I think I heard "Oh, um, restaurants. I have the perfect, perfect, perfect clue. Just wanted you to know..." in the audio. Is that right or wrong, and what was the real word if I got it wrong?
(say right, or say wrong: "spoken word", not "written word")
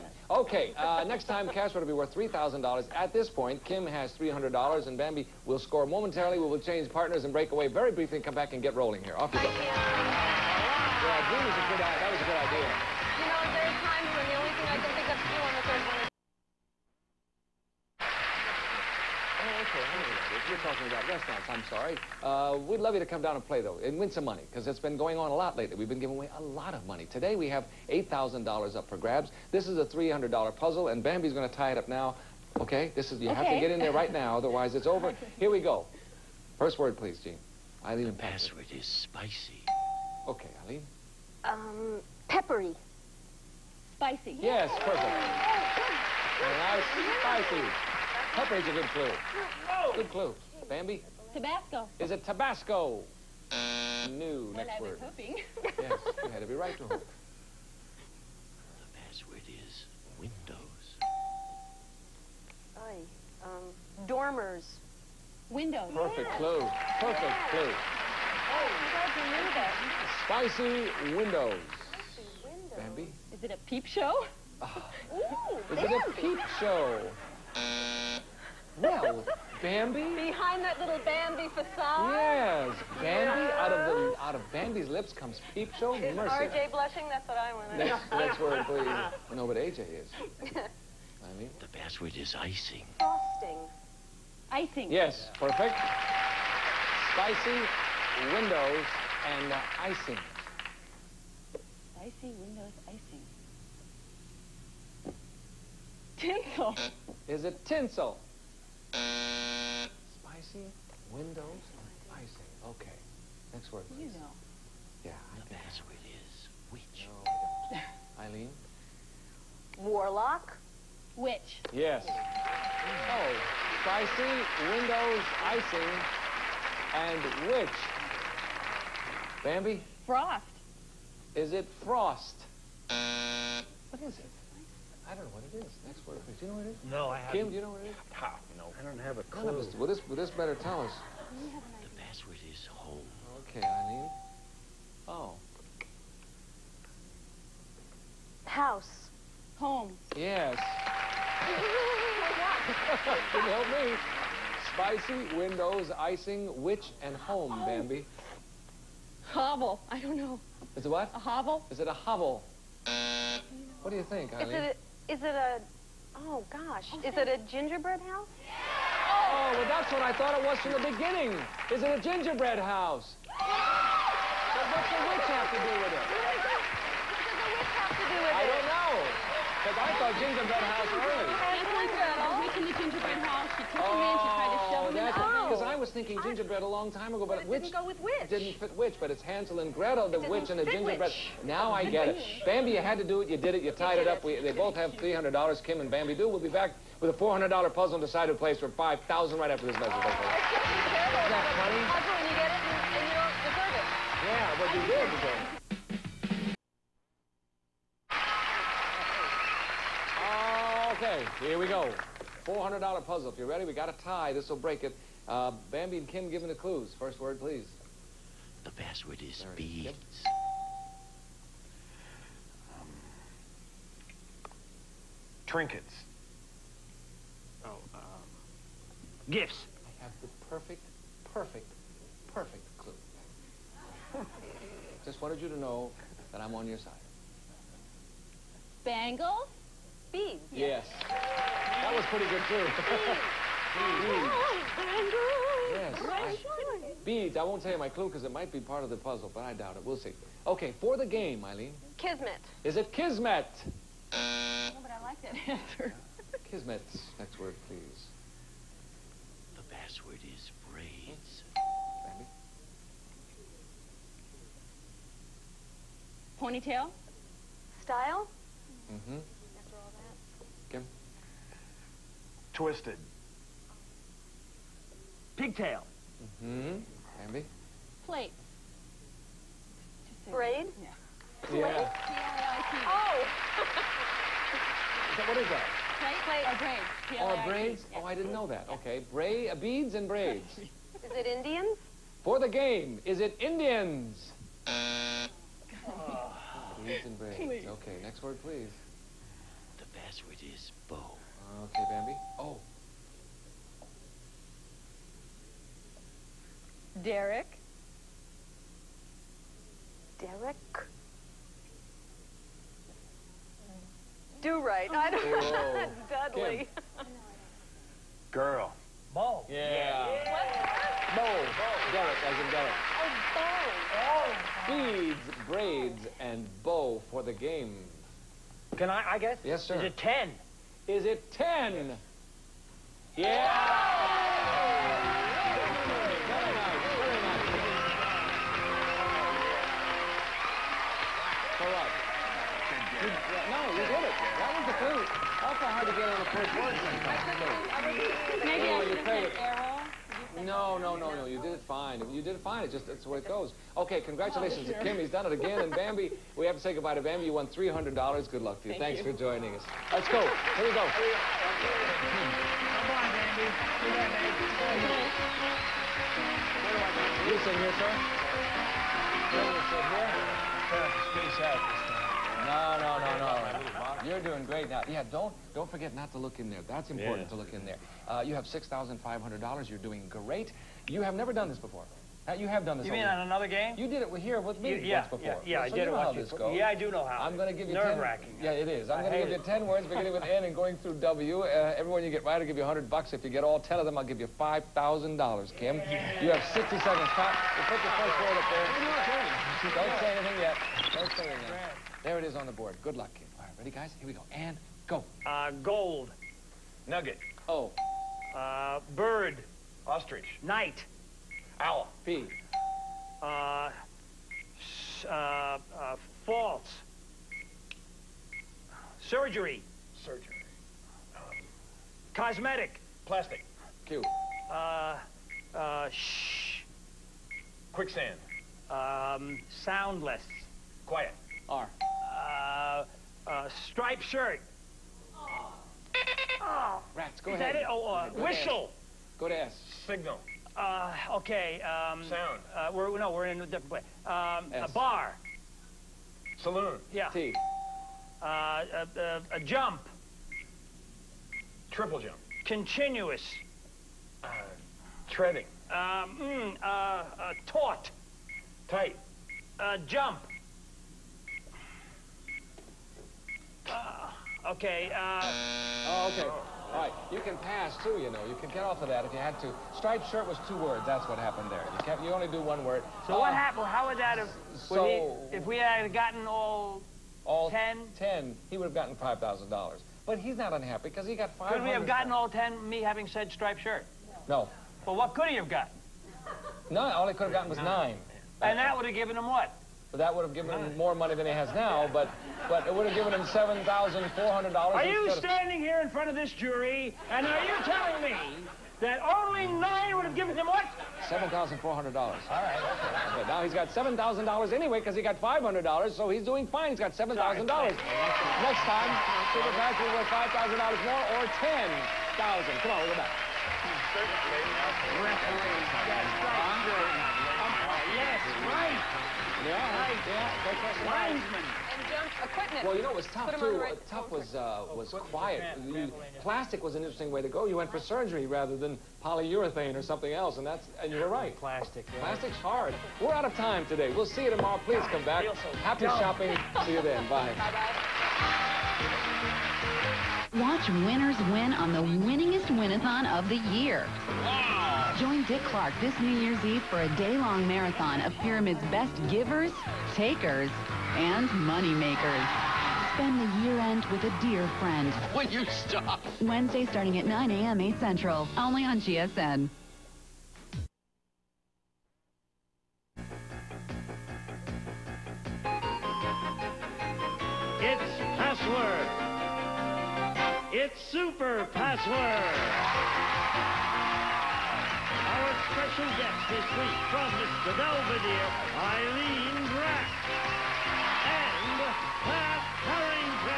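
wrong: "gifts", not "restaurants".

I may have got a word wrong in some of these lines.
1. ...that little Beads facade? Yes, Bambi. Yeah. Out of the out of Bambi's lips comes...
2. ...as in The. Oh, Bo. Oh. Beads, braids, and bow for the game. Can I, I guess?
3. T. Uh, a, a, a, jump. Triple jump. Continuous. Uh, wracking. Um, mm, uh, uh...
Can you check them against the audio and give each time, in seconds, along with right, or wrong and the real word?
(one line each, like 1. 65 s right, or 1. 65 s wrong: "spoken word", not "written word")
1. 80 s wrong: "Bambi", not "Beads"
2. 322 s wrong: "Derek", not "The"
3. 447 s wrong: "treading", not "wracking".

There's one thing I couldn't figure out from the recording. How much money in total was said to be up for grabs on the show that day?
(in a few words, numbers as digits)
$8,000.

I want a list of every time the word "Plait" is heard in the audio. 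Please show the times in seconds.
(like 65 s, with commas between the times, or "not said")
281 s, 286 s.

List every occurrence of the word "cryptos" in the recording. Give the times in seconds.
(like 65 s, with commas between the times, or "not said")
not said.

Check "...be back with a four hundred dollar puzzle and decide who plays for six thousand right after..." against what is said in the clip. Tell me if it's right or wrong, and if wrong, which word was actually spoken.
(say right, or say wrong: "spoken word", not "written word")
wrong: "five", not "six".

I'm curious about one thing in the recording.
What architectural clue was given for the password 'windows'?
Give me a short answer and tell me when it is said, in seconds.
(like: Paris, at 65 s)
dormers, at 64 s.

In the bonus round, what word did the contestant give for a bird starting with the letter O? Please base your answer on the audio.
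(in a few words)
Ostrich.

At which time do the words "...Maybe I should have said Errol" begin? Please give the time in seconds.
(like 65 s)
348 s.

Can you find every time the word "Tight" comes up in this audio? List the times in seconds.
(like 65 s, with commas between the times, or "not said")
458 s.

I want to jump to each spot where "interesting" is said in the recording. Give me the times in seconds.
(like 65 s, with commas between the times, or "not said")
526 s.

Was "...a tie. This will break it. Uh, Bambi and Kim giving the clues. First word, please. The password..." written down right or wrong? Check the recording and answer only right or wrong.
right.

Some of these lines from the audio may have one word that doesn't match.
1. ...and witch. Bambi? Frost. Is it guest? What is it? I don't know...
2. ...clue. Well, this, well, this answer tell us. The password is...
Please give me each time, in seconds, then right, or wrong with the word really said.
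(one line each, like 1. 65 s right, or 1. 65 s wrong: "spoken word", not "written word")
1. 126 s wrong: "frost", not "guest"
2. 139 s wrong: "better", not "answer".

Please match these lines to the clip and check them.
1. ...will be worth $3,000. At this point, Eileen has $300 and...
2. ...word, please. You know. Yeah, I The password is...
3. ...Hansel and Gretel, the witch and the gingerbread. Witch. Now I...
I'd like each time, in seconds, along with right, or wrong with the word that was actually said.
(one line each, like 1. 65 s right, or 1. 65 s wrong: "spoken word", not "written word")
1. 1 s wrong: "Kim", not "Eileen"
2. 113 s right
3. 189 s right.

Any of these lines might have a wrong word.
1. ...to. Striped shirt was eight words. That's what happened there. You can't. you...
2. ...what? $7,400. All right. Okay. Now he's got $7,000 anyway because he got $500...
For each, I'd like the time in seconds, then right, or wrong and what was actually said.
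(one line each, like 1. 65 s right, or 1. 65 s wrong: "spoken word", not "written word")
1. 469 s wrong: "two", not "eight"
2. 500 s right.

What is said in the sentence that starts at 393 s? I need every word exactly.
If you get all ten of them, I'll give you five thousand dollars, Kim.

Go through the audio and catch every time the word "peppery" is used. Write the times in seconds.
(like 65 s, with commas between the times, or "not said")
42 s, 48 s.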